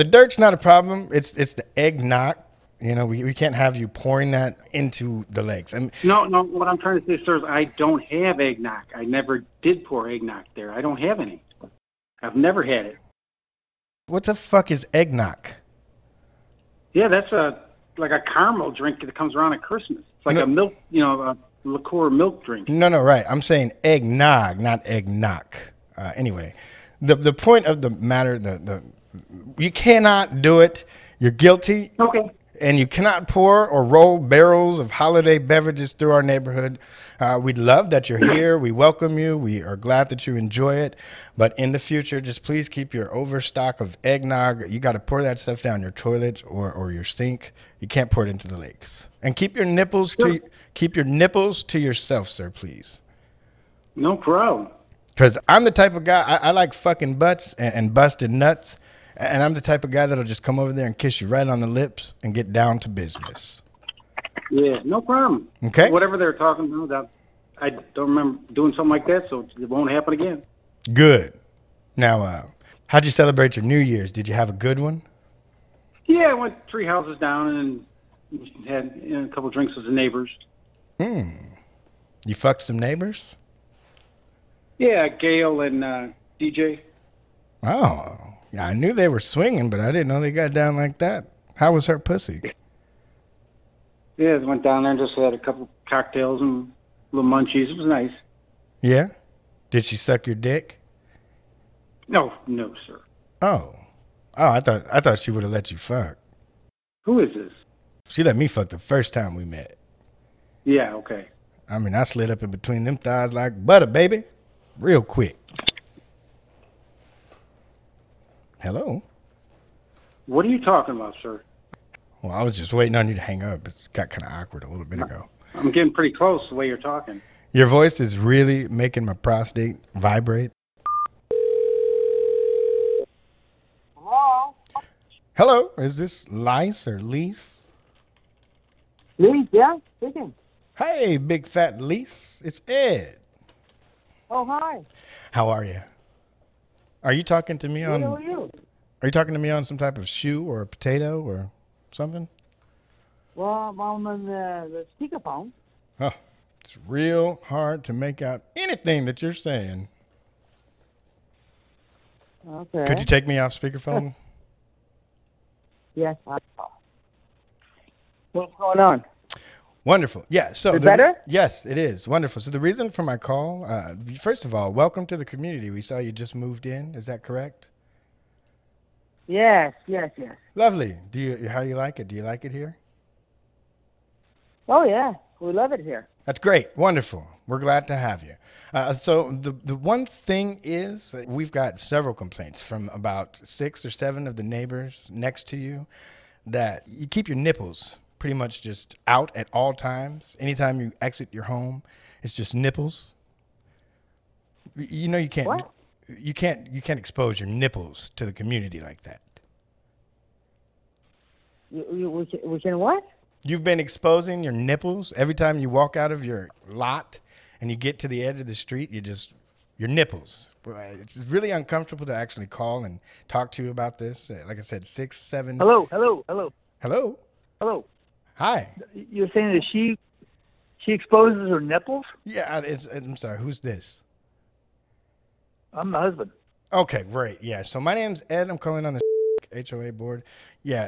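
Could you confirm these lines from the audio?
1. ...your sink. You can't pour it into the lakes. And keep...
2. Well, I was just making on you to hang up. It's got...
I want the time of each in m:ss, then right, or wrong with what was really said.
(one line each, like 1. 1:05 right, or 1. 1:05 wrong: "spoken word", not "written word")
1. 0:46 right
2. 2:02 wrong: "waiting", not "making".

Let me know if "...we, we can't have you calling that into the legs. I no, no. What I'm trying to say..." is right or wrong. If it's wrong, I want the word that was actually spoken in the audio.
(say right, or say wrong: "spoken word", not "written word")
wrong: "pouring", not "calling".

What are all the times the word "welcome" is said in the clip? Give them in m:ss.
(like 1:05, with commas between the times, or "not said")
0:38, 2:54.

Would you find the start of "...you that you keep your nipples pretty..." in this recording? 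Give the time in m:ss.
3:15.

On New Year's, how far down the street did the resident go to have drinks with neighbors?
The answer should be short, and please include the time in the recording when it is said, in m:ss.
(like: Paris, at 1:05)
three houses, at 1:16.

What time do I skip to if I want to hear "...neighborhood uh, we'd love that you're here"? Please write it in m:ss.
0:36.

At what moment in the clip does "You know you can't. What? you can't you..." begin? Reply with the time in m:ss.
3:24.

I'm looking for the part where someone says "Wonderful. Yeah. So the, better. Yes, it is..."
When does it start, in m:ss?
2:49.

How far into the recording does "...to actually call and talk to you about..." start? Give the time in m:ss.
3:42.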